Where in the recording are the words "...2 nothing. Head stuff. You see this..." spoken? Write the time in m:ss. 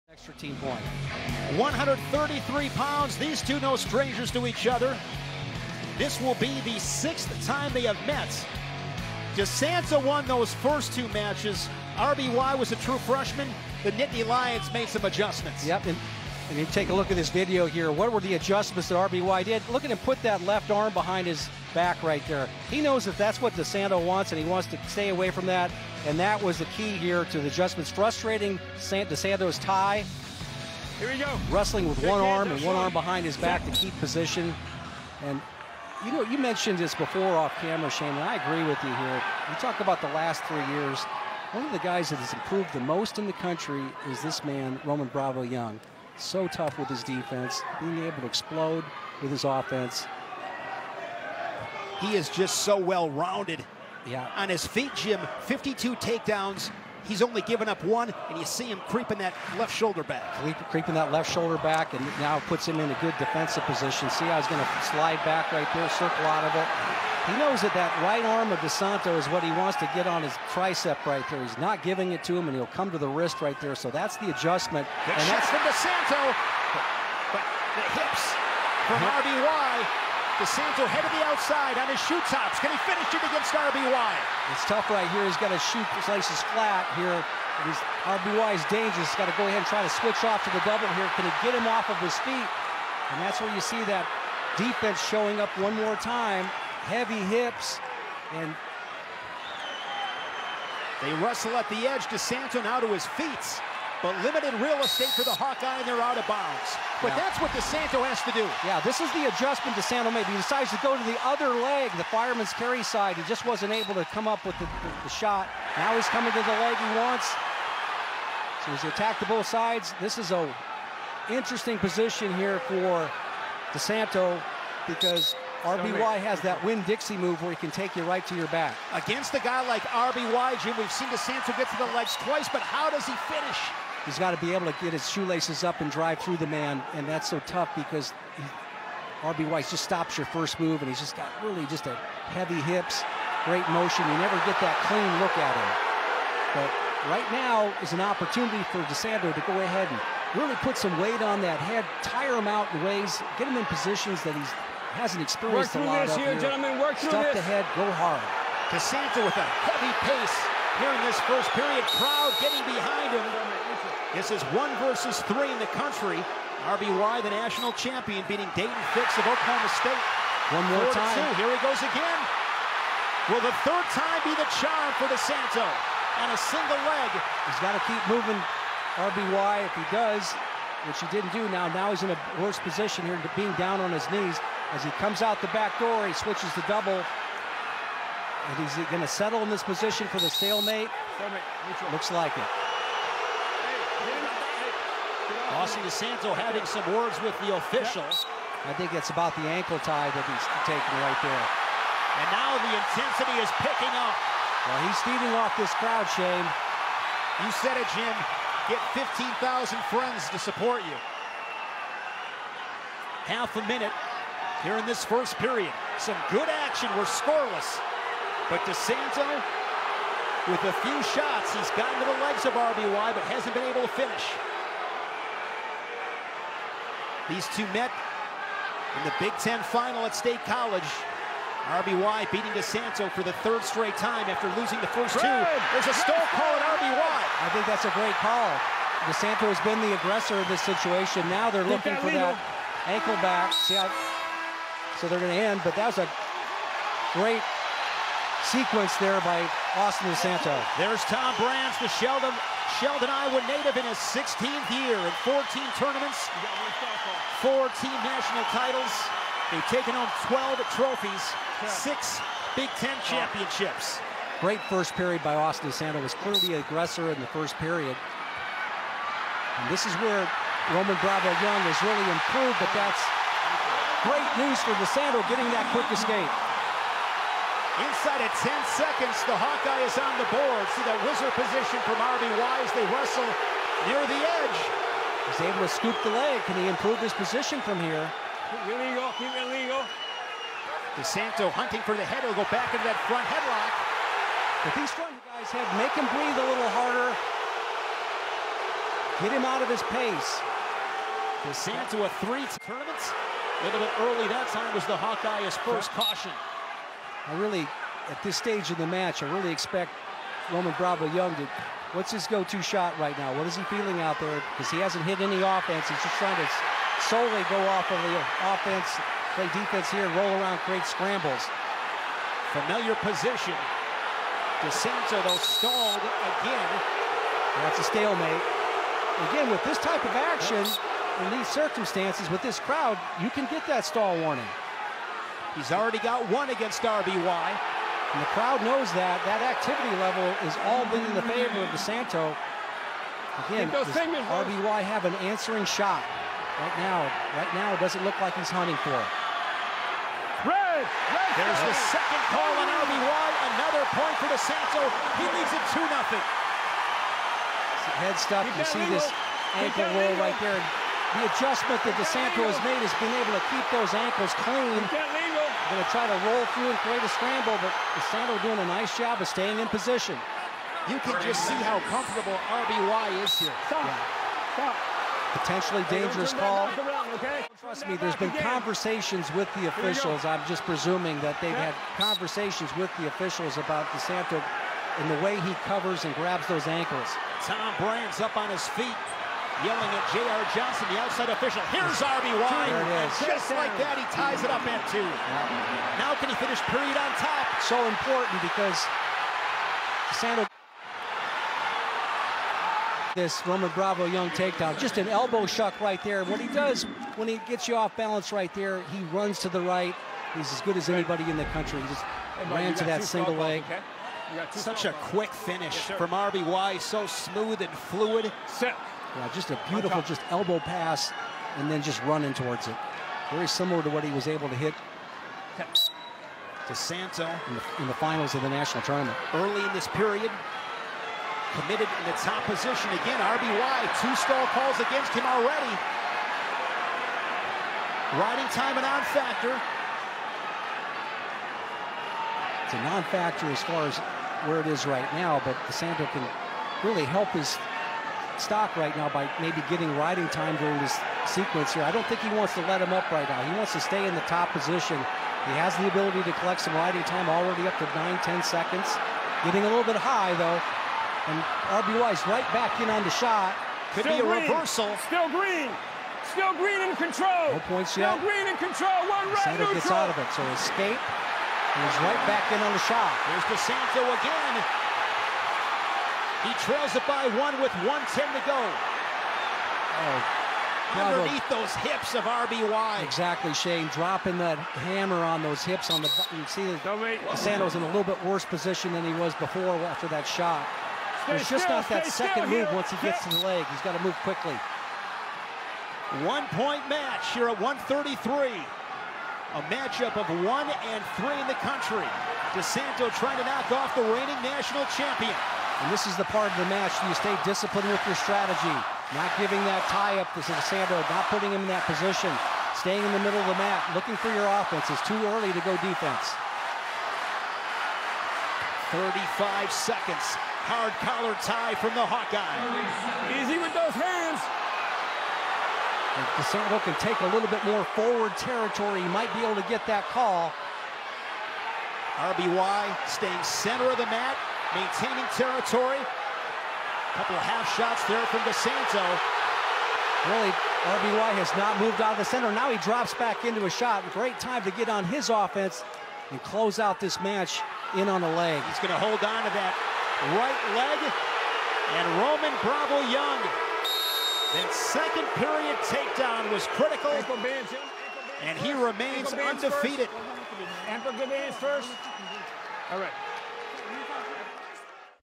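5:55.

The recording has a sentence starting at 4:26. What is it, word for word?
Was clearly the aggressor in the first period.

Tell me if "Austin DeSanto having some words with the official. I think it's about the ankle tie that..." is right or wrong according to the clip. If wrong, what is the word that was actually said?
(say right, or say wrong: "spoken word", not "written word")
right.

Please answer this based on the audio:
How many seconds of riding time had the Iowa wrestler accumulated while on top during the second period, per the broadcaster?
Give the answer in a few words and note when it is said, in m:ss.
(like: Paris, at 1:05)
9 to 10 seconds, at 7:37.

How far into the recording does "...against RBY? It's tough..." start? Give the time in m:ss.
1:23.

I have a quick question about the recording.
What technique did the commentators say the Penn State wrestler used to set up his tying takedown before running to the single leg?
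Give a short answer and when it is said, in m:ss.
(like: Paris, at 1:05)
elbow shuck, at 6:45.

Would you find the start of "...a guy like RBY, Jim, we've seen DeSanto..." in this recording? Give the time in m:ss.
2:09.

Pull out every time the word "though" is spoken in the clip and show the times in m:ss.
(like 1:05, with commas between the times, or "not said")
5:25, 7:40.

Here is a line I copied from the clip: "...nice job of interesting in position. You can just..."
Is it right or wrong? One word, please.
wrong.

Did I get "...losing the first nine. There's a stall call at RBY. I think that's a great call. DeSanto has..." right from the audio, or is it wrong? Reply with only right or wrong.
wrong.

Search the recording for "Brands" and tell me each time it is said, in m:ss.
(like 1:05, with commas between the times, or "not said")
4:11, 6:27.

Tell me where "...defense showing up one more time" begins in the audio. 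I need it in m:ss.
1:34.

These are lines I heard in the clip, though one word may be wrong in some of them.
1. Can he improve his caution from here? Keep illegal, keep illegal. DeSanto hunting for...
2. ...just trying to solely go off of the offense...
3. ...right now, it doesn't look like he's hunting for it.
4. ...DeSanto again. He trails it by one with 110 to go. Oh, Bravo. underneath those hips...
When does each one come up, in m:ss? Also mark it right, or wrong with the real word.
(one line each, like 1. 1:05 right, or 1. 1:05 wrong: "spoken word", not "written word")
1. 4:46 wrong: "position", not "caution"
2. 5:15 right
3. 5:47 right
4. 7:53 right.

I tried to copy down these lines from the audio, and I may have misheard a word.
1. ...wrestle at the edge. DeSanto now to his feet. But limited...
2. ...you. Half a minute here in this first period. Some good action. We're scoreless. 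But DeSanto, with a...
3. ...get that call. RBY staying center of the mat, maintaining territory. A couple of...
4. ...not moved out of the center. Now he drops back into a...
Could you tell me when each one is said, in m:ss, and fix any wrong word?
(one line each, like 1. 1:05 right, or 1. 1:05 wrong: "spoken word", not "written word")
1. 1:41 right
2. 3:30 right
3. 8:49 right
4. 9:01 right.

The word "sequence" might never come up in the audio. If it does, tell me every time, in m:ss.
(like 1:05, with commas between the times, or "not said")
4:08, 7:31.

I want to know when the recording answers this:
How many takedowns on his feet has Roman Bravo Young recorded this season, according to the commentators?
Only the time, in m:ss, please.
0:55.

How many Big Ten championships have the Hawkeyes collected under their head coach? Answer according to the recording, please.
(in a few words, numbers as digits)
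6.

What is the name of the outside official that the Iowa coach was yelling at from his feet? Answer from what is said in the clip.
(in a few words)
J.R. Johnson.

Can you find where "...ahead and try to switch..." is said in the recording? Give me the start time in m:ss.
1:29.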